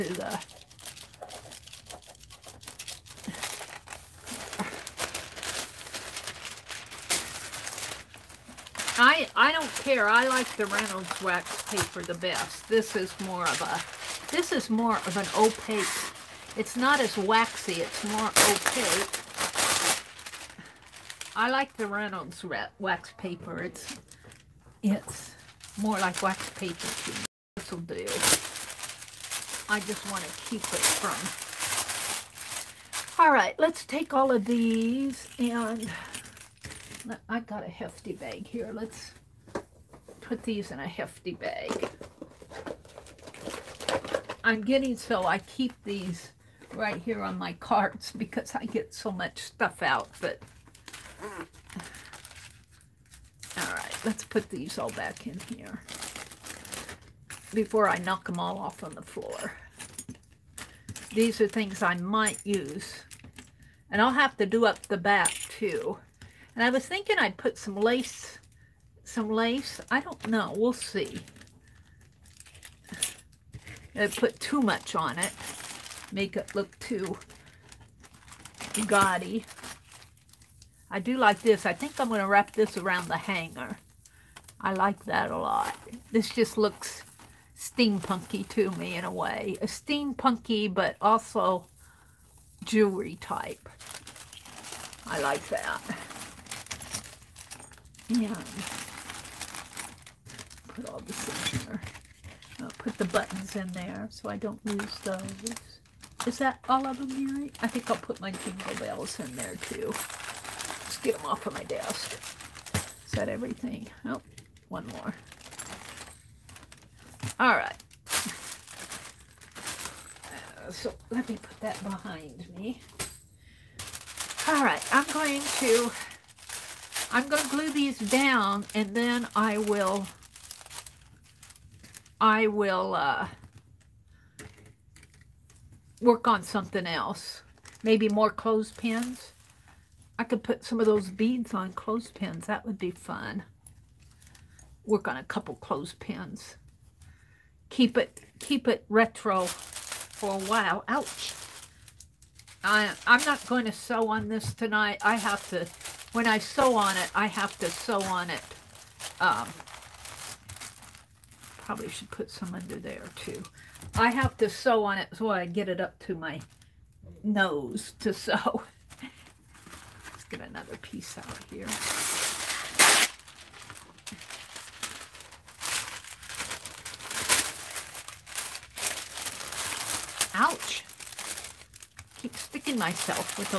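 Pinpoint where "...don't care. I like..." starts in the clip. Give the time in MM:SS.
00:09.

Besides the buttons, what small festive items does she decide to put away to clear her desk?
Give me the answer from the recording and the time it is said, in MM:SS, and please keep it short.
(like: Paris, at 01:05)
Jingle bells, at 01:48.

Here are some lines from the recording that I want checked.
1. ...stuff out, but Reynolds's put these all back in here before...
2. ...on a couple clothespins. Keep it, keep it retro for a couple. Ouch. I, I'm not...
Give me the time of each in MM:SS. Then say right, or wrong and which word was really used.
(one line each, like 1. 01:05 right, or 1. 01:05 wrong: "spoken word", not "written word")
1. 00:49 wrong: "Let", not "Reynolds"
2. 02:25 wrong: "while", not "couple".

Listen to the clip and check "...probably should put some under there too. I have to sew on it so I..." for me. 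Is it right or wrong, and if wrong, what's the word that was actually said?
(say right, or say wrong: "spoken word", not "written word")
right.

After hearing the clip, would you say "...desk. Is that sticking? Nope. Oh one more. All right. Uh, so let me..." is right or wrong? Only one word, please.
wrong.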